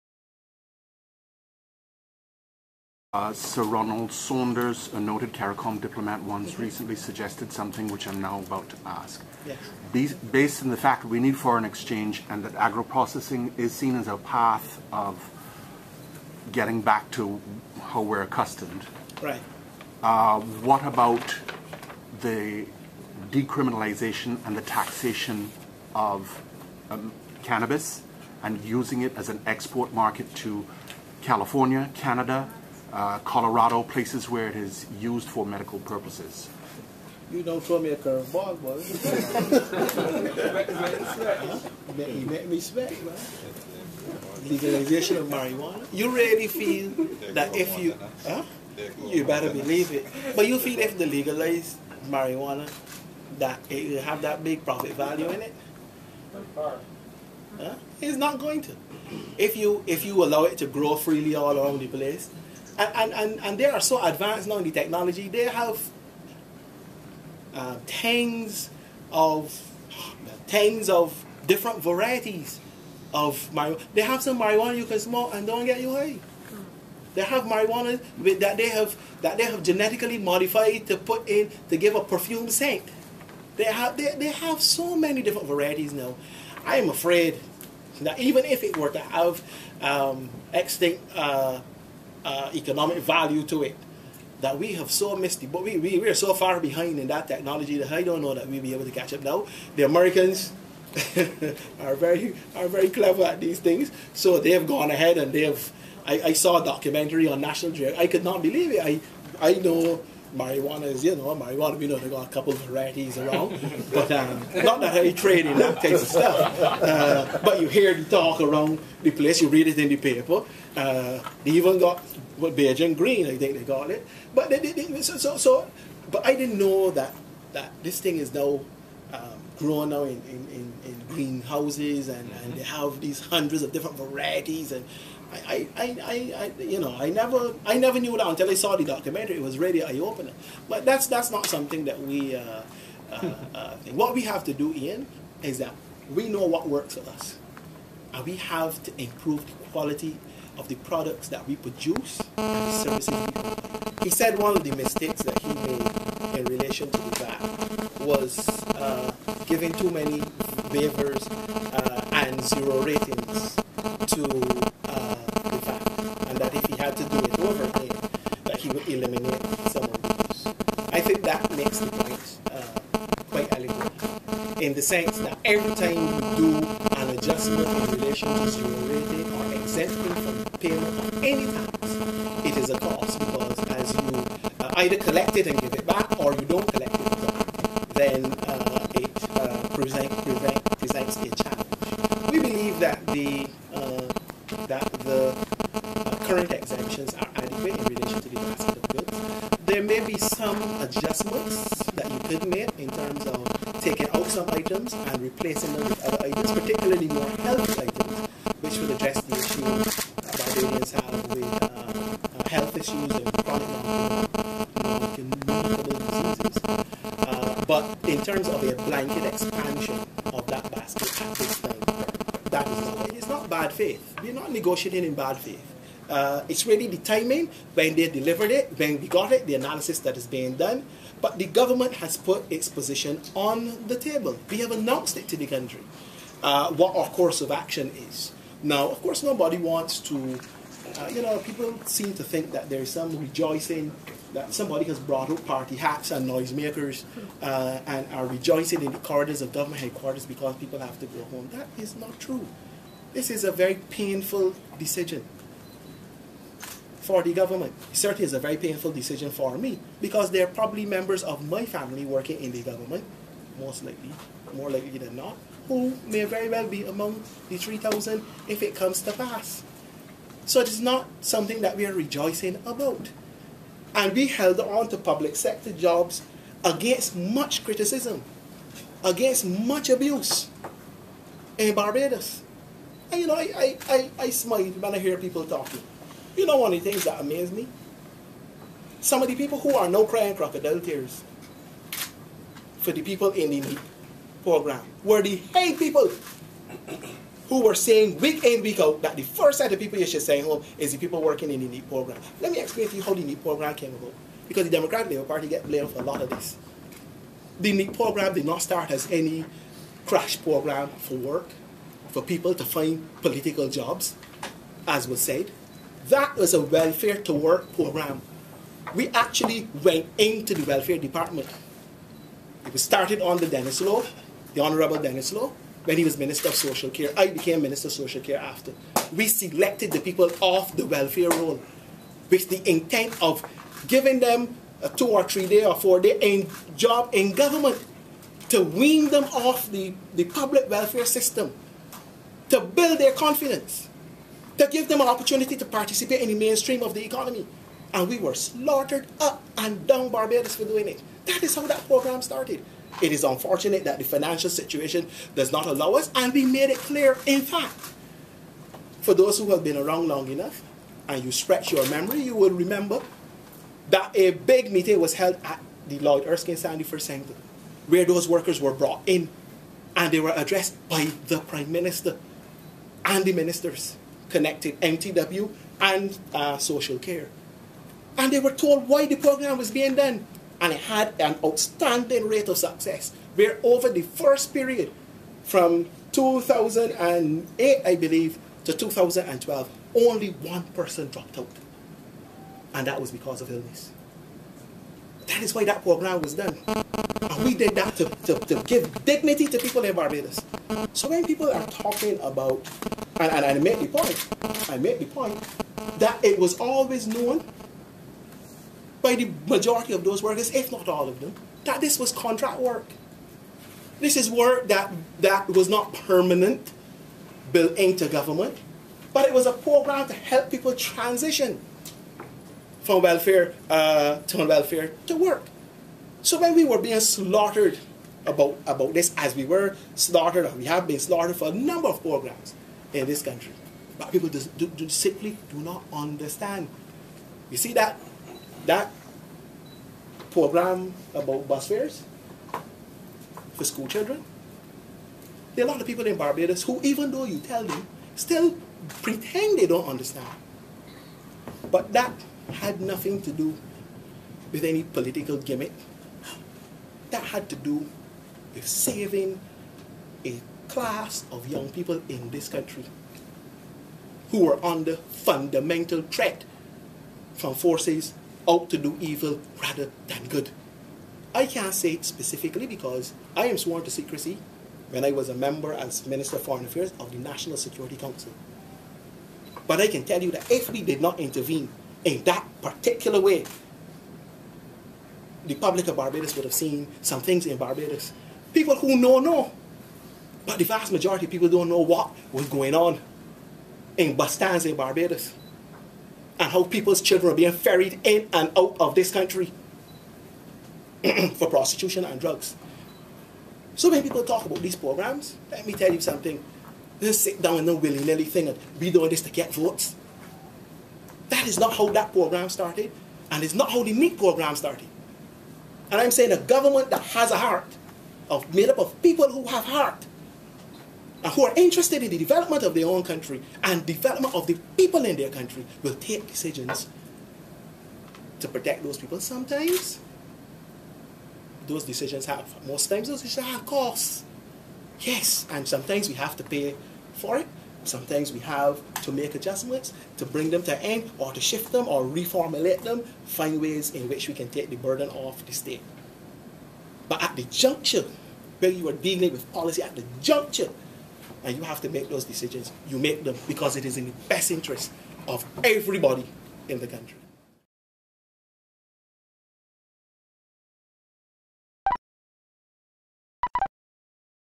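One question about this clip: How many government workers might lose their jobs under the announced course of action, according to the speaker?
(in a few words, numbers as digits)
3,000.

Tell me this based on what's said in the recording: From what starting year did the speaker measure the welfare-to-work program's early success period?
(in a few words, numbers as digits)
2008.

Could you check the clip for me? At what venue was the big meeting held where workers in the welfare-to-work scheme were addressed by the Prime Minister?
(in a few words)
Lloyd Erskine Sandiford Center.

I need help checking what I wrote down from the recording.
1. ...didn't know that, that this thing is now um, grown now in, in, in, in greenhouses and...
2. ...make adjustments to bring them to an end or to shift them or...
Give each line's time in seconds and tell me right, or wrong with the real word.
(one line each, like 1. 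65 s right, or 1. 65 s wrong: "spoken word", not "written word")
1. 126 s right
2. 539 s right.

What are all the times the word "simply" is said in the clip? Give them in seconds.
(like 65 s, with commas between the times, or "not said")
434 s.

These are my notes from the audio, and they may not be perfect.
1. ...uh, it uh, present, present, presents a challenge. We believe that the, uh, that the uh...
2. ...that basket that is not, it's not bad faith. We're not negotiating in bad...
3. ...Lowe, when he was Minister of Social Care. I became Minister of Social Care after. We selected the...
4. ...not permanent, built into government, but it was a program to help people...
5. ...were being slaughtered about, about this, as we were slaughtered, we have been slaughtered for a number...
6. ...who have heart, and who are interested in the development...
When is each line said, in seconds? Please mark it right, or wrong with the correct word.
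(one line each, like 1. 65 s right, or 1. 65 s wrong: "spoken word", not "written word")
1. 188 s right
2. 220 s right
3. 325 s right
4. 415 s right
5. 426 s right
6. 519 s right.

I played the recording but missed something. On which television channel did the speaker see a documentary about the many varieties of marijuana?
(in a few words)
National Geographic.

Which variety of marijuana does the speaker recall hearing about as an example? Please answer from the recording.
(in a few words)
Beijing green.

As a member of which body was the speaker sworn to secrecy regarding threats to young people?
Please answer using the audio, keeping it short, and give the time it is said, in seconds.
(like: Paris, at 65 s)
National Security Council, at 477 s.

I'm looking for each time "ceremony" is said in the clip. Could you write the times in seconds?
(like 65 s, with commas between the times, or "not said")
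not said.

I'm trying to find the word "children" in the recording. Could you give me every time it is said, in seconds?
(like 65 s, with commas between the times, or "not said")
443 s, 497 s.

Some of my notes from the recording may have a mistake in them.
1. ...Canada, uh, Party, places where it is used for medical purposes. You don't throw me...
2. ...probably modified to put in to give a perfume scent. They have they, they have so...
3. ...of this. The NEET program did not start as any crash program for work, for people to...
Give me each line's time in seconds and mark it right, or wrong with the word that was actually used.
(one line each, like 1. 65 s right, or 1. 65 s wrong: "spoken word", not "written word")
1. 31 s wrong: "Colorado", not "Party"
2. 79 s wrong: "genetically", not "probably"
3. 306 s right.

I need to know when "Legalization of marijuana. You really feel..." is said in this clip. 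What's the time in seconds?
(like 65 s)
44 s.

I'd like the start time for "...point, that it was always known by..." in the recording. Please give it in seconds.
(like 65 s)
405 s.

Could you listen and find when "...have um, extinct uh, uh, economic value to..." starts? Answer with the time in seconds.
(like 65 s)
88 s.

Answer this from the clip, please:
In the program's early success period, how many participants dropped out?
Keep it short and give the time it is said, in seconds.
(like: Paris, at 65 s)
1, at 389 s.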